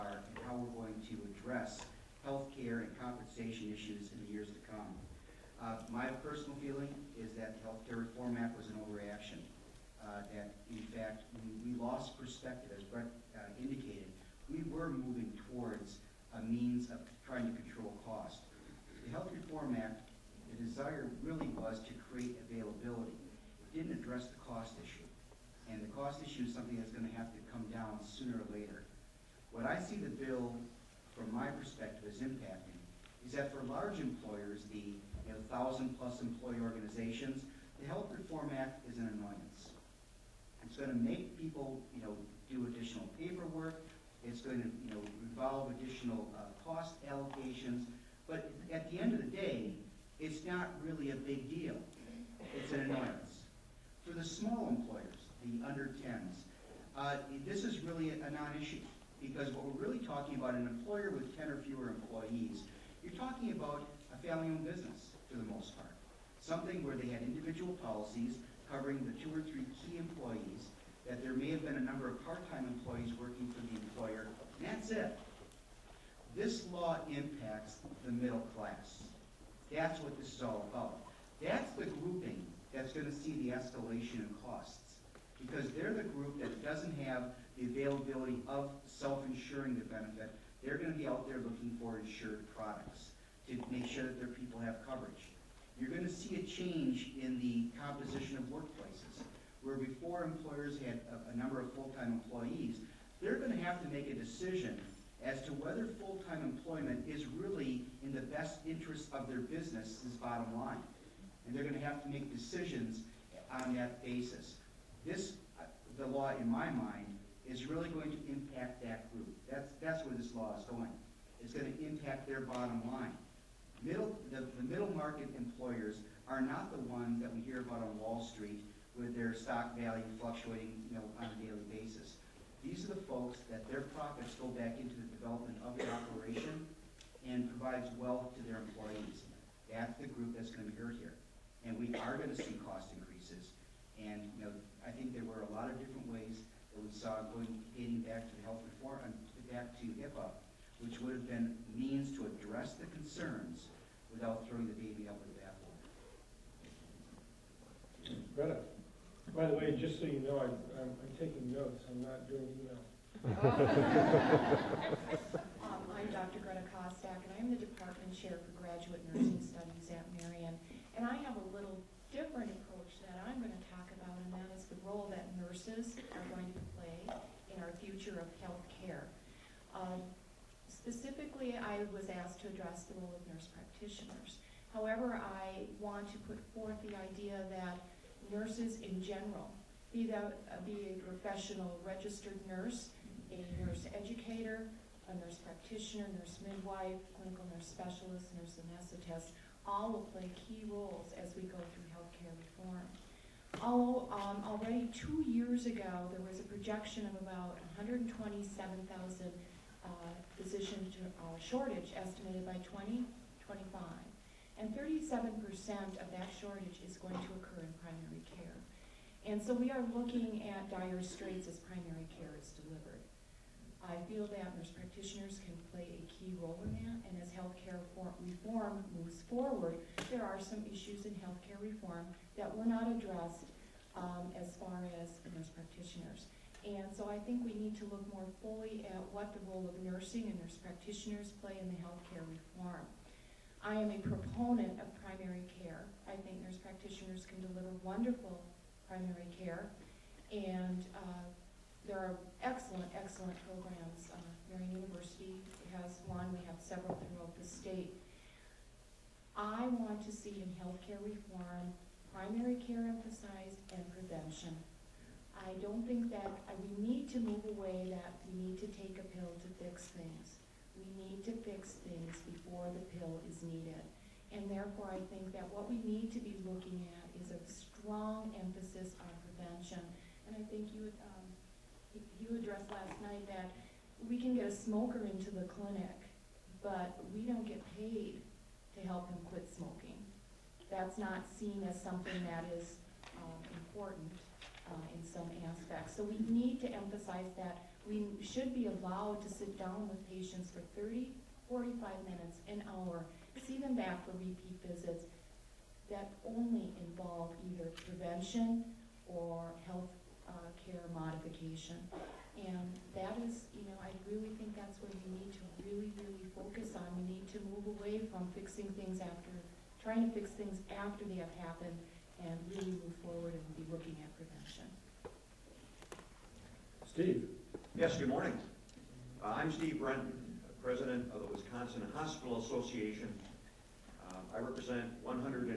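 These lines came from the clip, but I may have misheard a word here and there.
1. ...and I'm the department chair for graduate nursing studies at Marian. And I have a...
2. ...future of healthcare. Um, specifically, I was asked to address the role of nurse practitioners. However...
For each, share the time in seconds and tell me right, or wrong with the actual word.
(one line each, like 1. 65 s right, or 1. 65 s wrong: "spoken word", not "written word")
1. 167 s right
2. 177 s right.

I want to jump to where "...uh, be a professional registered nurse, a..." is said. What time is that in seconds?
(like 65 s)
190 s.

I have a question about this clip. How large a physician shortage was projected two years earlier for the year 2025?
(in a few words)
127,000.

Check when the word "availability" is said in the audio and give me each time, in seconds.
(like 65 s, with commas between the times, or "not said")
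22 s, 87 s.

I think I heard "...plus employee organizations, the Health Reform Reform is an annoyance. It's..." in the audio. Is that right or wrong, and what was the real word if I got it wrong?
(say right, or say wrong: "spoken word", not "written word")
wrong: "Act", not "Reform".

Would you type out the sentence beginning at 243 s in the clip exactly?
I am a proponent of primary care.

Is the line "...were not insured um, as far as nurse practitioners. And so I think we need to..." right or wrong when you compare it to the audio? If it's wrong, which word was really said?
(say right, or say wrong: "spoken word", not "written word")
wrong: "addressed", not "insured".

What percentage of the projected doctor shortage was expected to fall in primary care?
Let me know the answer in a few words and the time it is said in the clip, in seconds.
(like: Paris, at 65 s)
37%, at 214 s.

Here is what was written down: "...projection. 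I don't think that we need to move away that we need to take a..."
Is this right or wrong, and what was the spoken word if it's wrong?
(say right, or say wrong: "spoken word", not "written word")
wrong: "prevention", not "projection".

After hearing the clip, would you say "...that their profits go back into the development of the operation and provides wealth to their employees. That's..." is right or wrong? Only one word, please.
right.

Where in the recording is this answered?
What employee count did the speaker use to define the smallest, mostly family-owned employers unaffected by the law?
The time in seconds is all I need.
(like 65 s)
61 s.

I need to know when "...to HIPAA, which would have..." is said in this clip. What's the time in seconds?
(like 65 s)
149 s.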